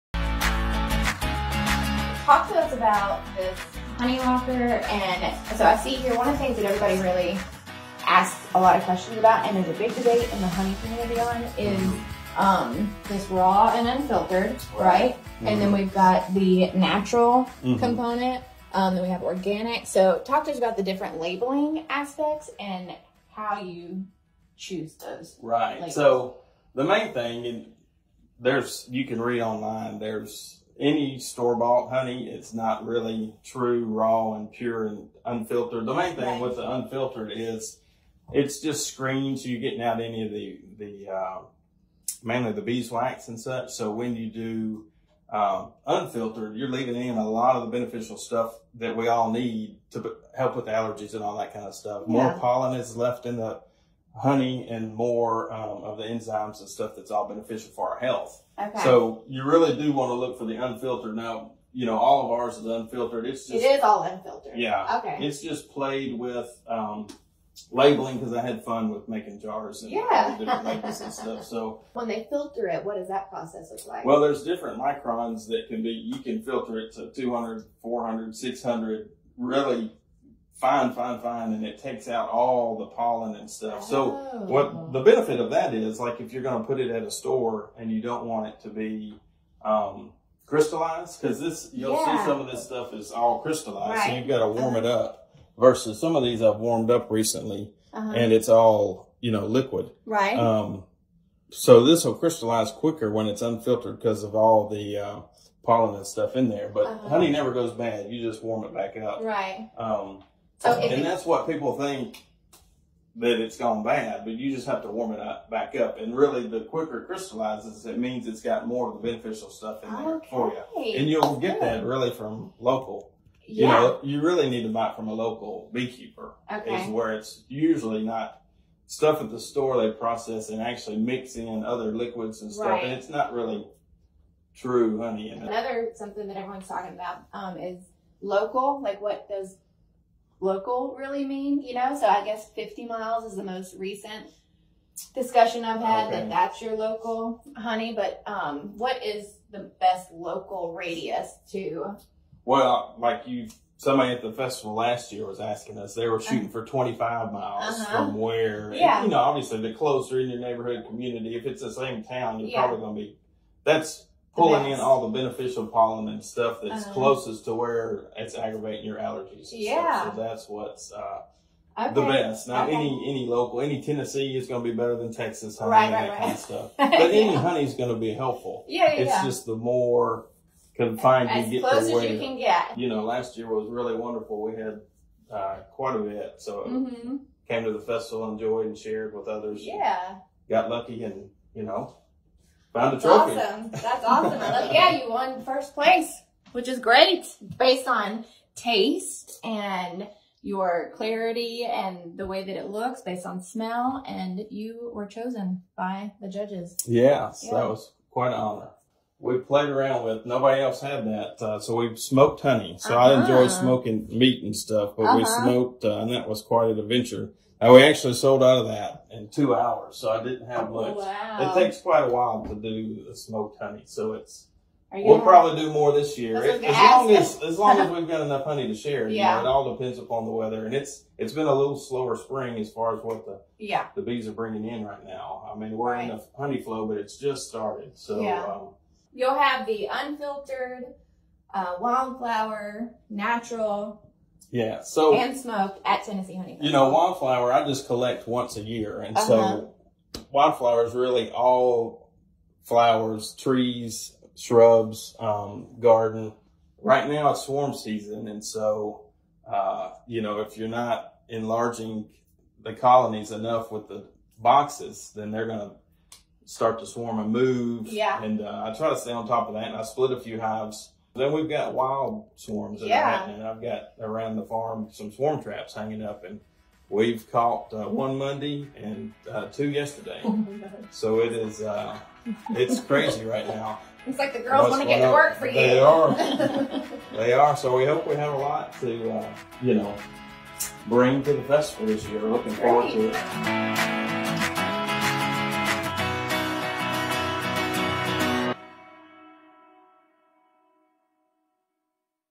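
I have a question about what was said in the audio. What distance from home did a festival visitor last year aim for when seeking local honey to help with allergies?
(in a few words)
25 miles.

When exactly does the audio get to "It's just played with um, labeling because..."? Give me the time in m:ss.
1:05.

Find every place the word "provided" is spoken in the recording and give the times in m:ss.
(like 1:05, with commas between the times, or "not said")
not said.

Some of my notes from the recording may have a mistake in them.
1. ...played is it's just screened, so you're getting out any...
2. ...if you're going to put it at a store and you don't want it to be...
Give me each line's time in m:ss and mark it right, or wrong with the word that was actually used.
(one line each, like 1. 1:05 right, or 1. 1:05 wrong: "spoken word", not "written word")
1. 0:36 wrong: "unfiltered", not "played"
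2. 1:26 right.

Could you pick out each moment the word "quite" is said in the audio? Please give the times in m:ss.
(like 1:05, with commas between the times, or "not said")
3:05, 3:28, 3:36, 3:41.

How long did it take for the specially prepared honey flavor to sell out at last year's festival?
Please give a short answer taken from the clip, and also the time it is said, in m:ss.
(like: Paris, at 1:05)
two hours, at 3:39.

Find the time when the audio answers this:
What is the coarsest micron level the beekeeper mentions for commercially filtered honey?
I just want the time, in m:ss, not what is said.
1:17.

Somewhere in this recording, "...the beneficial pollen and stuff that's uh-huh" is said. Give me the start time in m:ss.
2:45.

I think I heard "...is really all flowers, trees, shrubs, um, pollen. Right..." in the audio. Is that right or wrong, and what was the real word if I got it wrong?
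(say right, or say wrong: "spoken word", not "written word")
wrong: "garden", not "pollen".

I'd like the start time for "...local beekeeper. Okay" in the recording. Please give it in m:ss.
2:05.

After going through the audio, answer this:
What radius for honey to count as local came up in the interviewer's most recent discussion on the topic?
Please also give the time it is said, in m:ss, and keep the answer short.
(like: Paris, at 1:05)
50 miles, at 2:22.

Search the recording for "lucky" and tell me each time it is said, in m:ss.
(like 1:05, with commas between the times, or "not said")
3:10.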